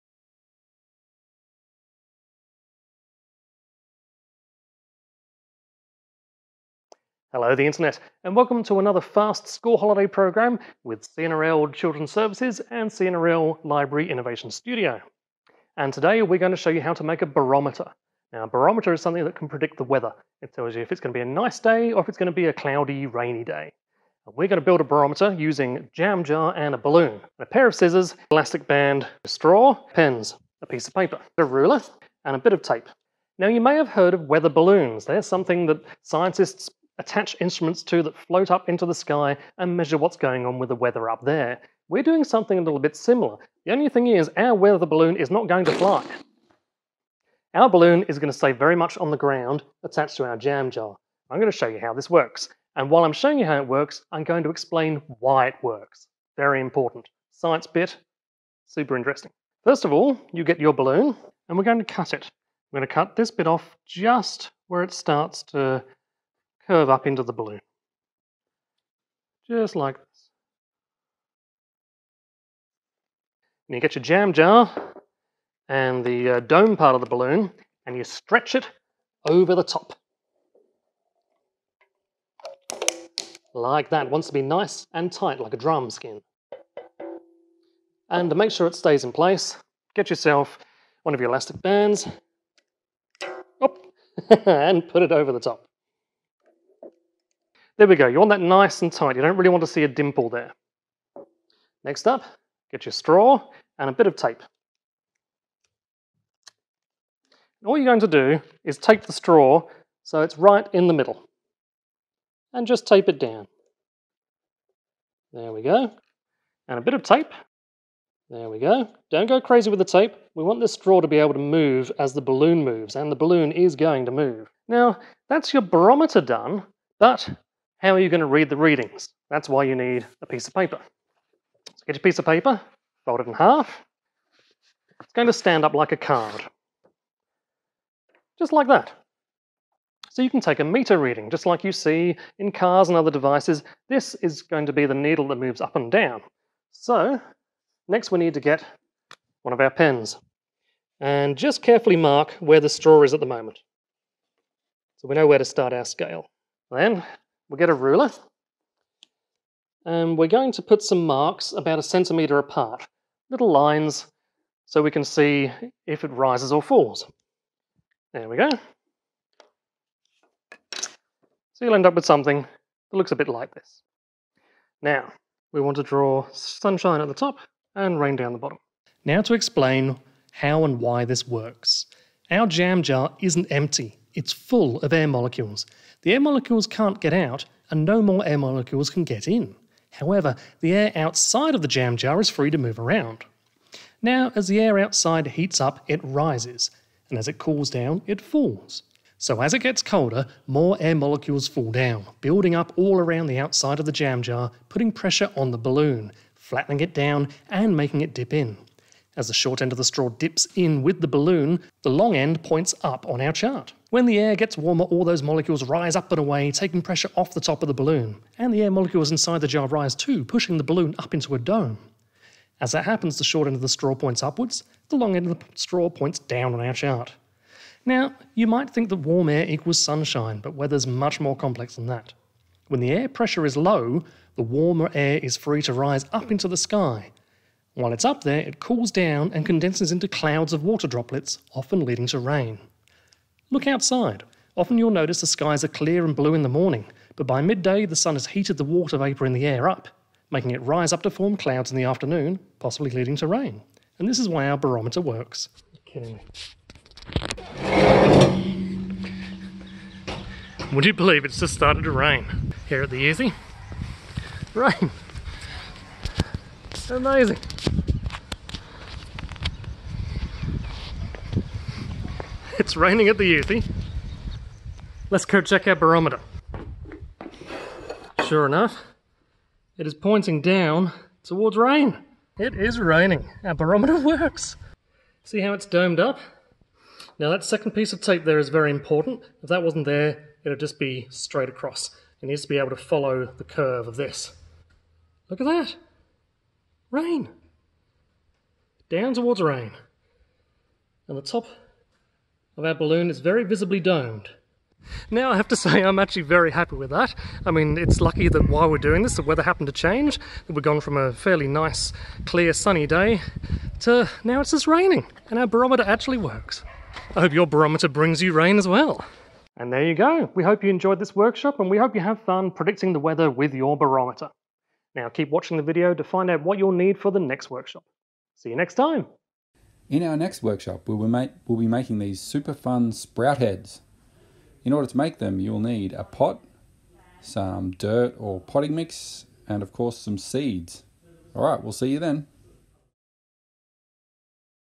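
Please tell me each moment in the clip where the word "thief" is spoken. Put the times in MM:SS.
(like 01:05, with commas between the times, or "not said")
not said.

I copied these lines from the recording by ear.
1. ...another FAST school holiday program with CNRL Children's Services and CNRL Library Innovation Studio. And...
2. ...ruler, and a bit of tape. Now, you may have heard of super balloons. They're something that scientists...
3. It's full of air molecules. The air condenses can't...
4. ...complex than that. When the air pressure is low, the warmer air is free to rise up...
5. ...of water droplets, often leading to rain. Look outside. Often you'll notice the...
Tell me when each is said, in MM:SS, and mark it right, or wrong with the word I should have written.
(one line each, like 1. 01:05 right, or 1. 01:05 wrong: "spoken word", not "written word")
1. 00:08 right
2. 00:31 wrong: "weather", not "super"
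3. 03:04 wrong: "molecules", not "condenses"
4. 03:51 right
5. 04:00 right.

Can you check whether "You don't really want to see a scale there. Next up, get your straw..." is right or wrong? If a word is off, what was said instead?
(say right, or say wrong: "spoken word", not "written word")
wrong: "dimple", not "scale".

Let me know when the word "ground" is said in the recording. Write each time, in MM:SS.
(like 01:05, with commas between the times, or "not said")
00:49.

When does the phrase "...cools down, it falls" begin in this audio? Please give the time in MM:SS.
03:17.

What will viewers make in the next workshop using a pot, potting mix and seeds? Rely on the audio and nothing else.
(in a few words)
sprout heads.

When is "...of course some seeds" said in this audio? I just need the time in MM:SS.
05:39.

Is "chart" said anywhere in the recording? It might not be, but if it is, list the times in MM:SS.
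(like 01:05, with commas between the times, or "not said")
03:33, 03:46.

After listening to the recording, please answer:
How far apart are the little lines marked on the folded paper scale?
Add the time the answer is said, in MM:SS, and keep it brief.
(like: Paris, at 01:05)
about a centimetre, at 02:41.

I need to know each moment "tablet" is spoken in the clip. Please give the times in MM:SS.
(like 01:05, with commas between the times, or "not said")
not said.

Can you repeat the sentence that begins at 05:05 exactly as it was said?
Now I have to say I'm actually very happy with that.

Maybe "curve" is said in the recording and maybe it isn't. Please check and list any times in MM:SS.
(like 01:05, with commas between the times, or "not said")
01:06, 04:53.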